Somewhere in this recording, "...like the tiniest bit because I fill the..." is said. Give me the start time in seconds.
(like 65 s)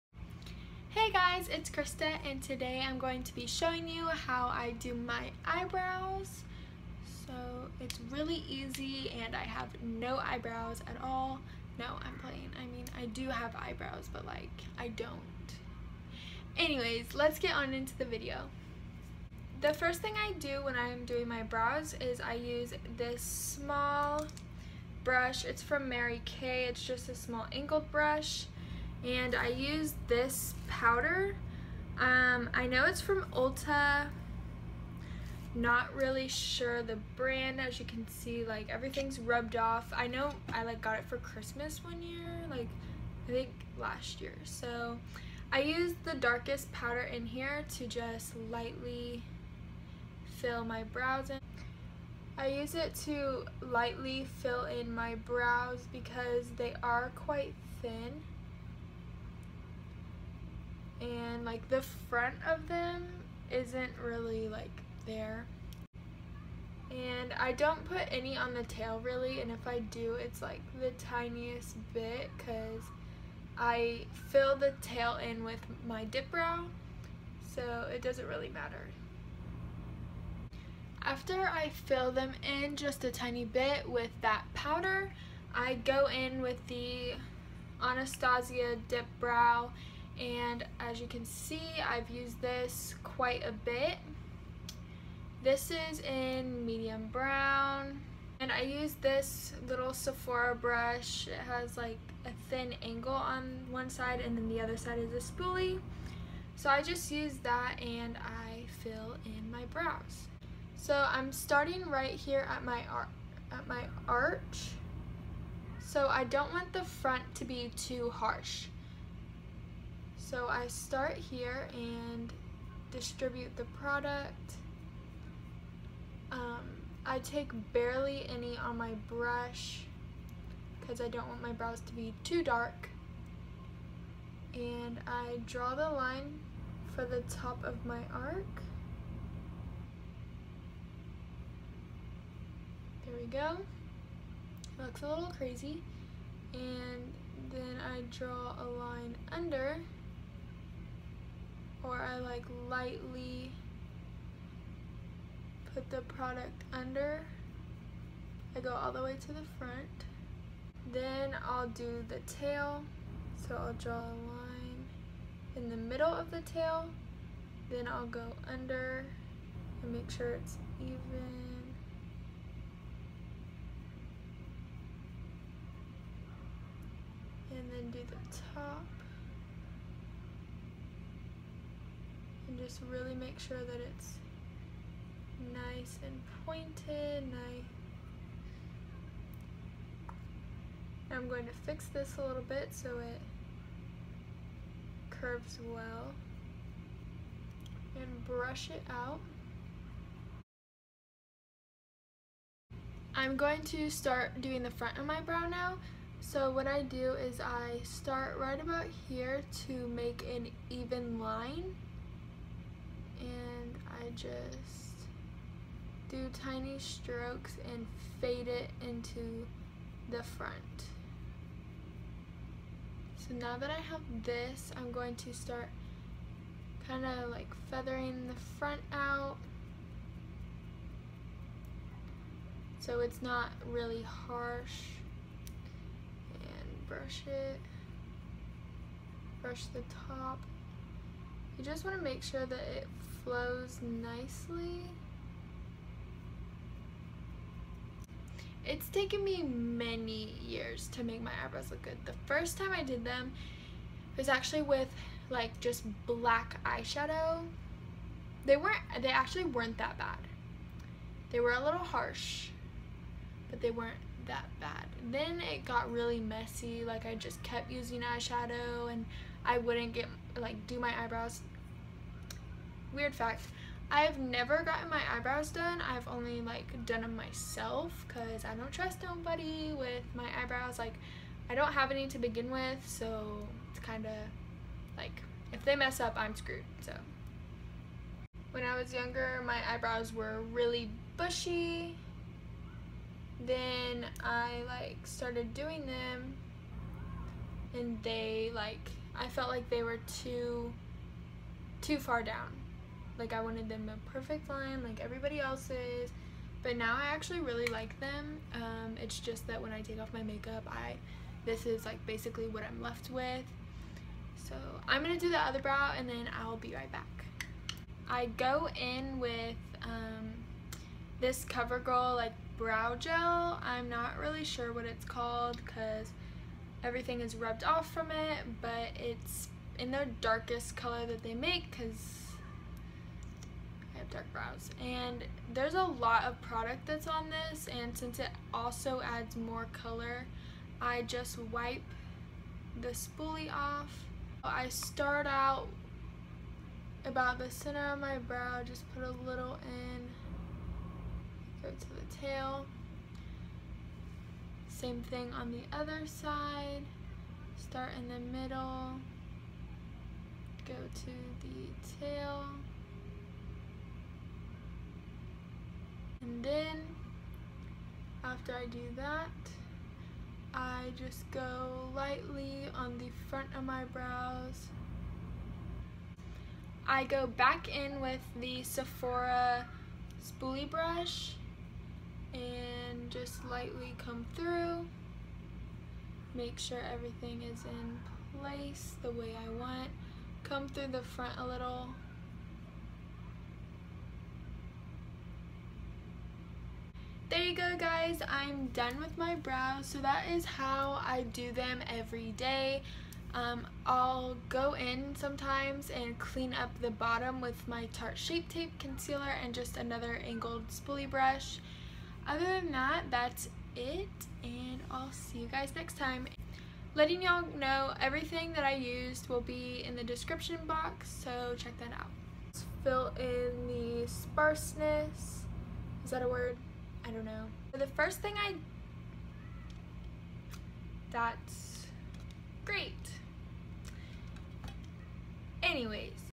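70 s.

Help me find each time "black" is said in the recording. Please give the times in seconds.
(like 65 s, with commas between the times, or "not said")
256 s.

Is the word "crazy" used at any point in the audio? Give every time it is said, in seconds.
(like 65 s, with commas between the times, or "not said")
145 s.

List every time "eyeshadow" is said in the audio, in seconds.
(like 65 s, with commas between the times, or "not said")
256 s, 268 s.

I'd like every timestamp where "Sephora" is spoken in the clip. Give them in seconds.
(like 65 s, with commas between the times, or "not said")
99 s, 378 s.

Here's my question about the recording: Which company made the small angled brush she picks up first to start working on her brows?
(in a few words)
Mary Kay.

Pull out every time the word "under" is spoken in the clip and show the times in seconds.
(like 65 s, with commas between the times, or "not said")
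149 s, 156 s, 168 s.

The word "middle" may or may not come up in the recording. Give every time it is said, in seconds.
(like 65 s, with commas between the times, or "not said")
165 s, 358 s.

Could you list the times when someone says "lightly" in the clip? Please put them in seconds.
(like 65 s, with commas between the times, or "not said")
48 s, 53 s, 152 s, 371 s, 383 s.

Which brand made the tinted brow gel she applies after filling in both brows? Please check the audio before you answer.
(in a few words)
CoverGirl.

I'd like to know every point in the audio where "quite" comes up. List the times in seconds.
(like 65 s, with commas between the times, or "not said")
57 s, 93 s.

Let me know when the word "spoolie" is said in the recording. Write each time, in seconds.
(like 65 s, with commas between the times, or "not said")
105 s, 342 s, 380 s, 410 s.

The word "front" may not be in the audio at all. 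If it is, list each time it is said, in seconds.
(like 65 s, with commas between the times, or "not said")
61 s, 116 s, 159 s, 204 s, 220 s, 228 s, 373 s, 391 s.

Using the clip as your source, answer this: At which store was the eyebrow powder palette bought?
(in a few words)
Ulta.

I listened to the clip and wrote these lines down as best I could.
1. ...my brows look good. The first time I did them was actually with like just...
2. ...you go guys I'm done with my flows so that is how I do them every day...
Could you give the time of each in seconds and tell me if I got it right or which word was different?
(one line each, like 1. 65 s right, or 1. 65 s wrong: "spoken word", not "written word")
1. 251 s wrong: "eyebrows", not "brows"
2. 397 s wrong: "brows", not "flows".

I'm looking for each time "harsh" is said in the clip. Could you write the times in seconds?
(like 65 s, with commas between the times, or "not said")
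118 s, 234 s, 261 s.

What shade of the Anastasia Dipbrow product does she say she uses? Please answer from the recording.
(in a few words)
Medium brown.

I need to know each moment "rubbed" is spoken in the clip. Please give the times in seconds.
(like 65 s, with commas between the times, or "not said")
39 s, 327 s.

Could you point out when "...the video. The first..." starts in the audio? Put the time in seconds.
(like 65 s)
17 s.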